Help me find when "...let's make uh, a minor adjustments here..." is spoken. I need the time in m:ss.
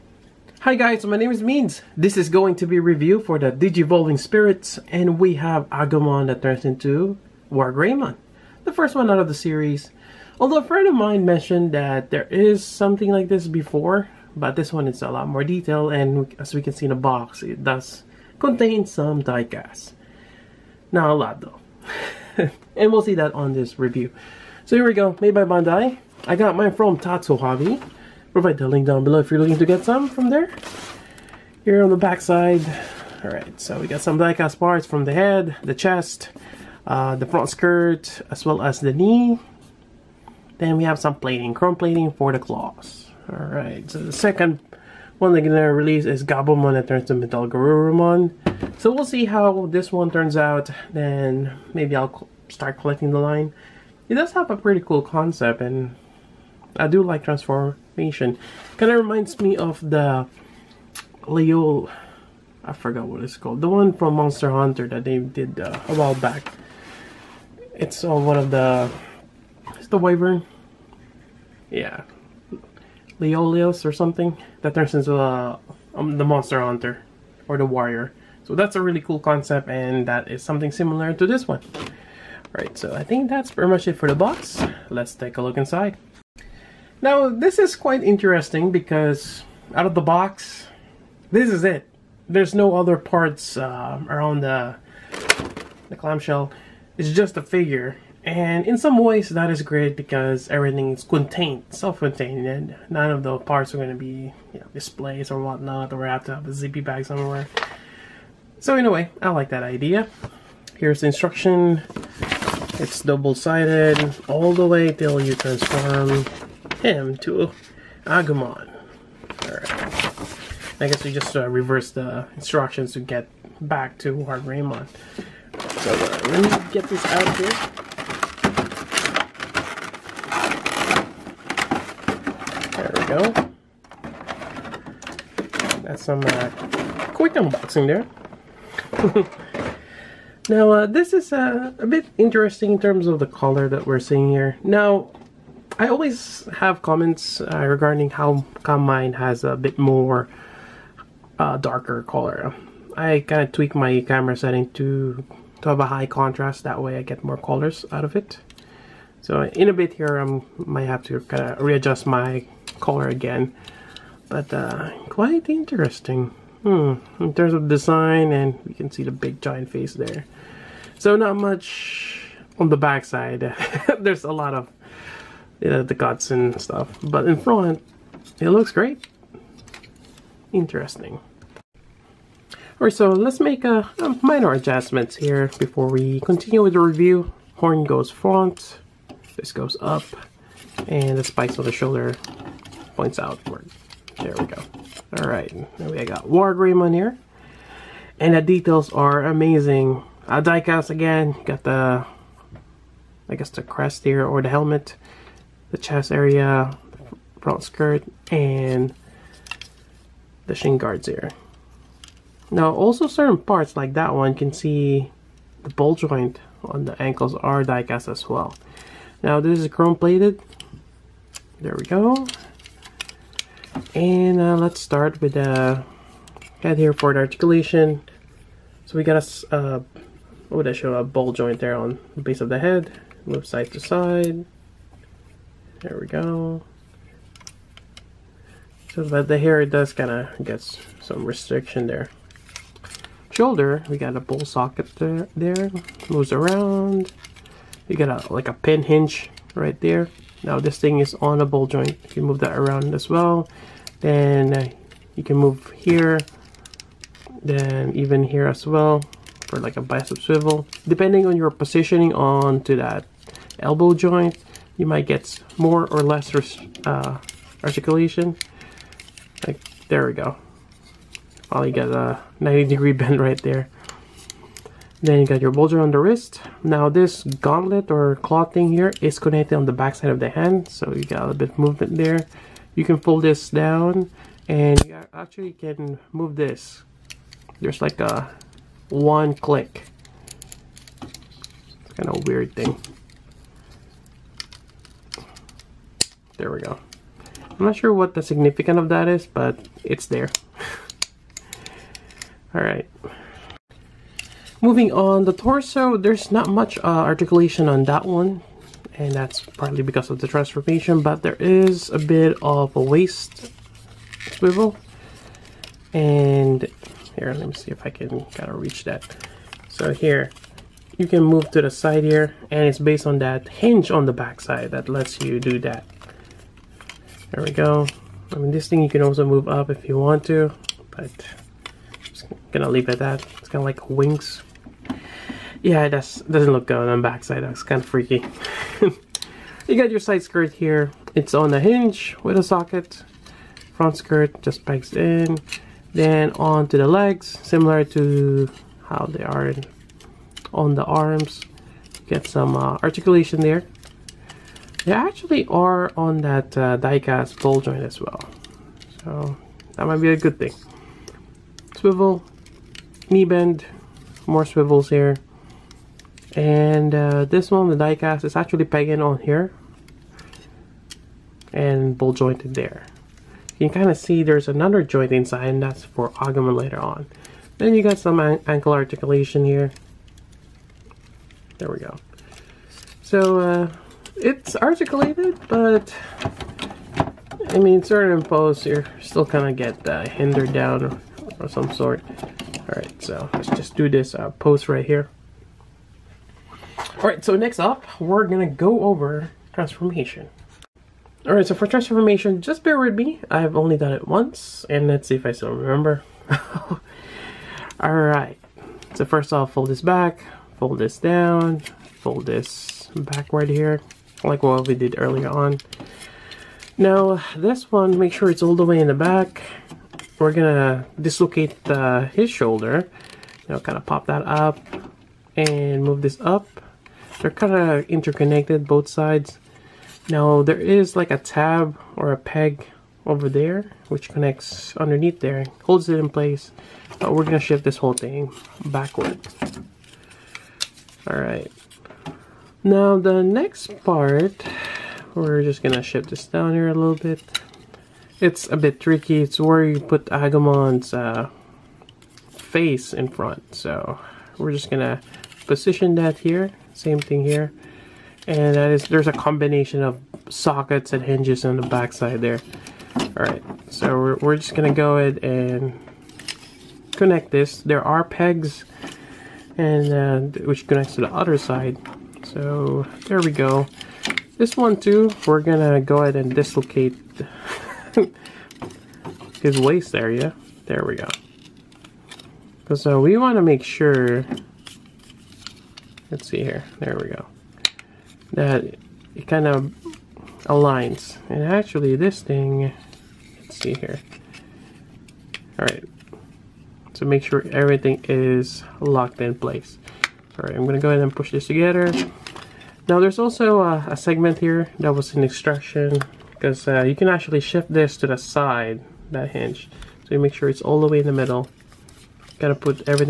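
3:03.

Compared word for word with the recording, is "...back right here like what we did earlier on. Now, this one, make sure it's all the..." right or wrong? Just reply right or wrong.
right.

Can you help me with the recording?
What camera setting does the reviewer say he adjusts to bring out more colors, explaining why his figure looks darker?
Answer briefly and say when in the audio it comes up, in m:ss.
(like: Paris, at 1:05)
High contrast, at 2:35.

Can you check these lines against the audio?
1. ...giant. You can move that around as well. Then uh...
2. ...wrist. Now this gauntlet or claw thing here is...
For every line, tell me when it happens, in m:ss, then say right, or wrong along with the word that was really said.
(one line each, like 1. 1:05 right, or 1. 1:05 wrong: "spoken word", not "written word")
1. 4:11 wrong: "joint", not "giant"
2. 4:35 right.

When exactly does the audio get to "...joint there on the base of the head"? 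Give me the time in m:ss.
3:51.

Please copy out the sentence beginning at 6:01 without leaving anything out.
Swivel, knee bend, more swivels here.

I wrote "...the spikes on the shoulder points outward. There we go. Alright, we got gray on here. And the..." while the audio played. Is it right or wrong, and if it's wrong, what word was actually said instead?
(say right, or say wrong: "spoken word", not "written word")
right.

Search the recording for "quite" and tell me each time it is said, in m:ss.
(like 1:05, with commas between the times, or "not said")
1:27, 2:45.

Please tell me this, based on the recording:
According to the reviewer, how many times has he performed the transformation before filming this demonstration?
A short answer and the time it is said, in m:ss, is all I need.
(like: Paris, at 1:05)
Once, at 6:44.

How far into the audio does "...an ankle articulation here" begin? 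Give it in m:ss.
6:18.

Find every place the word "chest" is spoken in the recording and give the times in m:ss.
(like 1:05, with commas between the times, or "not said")
0:35, 3:25.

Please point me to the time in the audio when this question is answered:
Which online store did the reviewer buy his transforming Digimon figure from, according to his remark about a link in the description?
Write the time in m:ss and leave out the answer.
0:26.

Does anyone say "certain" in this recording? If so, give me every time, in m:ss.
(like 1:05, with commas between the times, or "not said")
3:33, 6:27.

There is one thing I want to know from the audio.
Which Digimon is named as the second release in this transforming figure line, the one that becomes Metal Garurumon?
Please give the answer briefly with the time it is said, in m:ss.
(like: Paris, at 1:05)
Gabumon, at 0:46.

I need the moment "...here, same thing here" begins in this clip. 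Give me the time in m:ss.
7:36.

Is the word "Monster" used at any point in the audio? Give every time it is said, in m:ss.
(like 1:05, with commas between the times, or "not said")
1:04, 1:16.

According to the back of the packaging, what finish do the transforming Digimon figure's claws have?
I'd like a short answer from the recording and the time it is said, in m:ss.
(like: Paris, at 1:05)
Chrome plating, at 0:41.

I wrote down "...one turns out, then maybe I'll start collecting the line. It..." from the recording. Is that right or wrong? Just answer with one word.
right.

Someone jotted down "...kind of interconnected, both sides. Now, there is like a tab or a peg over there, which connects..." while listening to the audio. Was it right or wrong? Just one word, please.
right.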